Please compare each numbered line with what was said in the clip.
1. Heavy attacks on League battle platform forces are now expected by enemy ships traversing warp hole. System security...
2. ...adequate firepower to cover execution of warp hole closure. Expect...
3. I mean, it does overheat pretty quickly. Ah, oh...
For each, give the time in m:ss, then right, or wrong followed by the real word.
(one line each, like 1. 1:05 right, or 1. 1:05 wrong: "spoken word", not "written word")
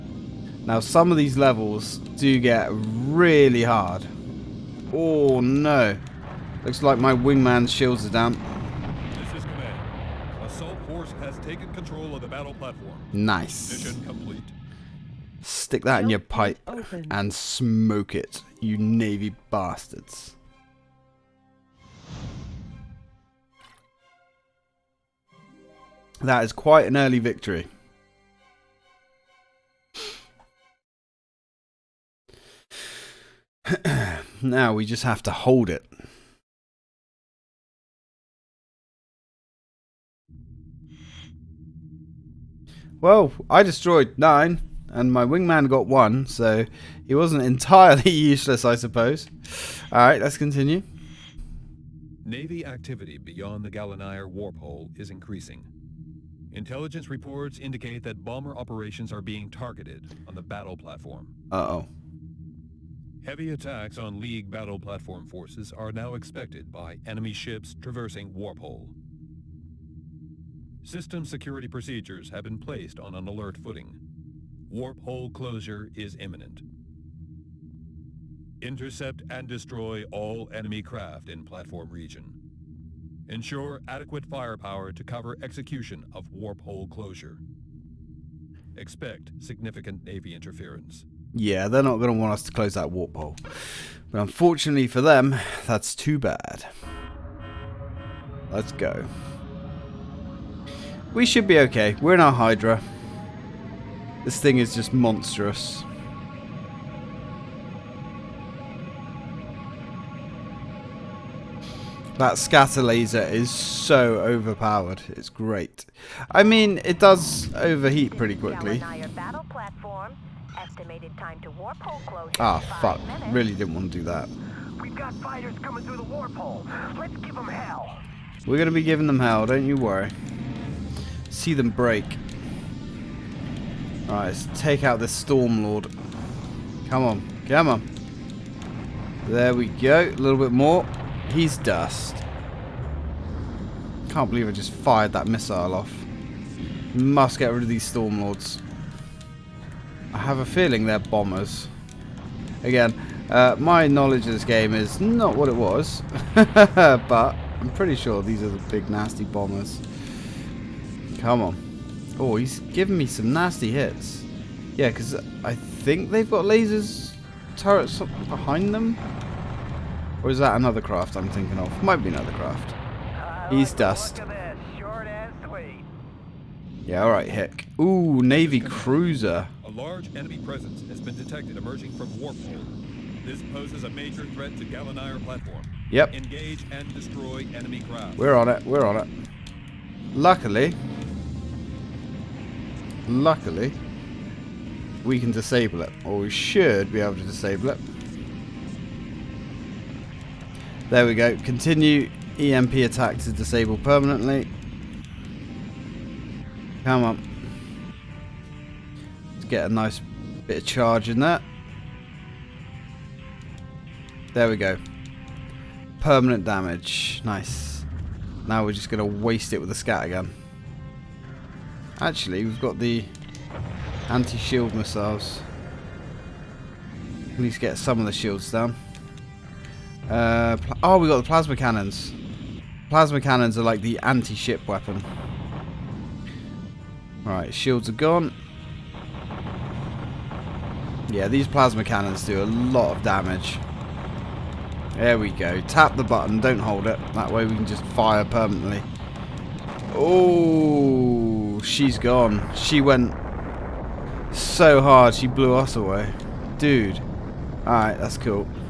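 1. 1:03 right
2. 1:23 right
3. 1:56 right.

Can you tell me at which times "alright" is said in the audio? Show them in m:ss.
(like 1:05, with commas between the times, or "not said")
0:49, 2:14, 2:57, 4:17.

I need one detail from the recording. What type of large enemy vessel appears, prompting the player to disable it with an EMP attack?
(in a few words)
Navy cruiser.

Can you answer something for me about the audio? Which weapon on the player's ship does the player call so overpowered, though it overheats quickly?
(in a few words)
scatter laser.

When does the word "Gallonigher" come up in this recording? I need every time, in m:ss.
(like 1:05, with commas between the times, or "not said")
0:53, 3:04.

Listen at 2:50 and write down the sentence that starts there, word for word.
Or is that another craft I'm thinking of?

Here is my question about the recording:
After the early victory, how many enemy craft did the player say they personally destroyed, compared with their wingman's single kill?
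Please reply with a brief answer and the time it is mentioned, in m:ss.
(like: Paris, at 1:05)
9, at 0:44.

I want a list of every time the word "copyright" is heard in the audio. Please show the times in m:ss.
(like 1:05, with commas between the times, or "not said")
not said.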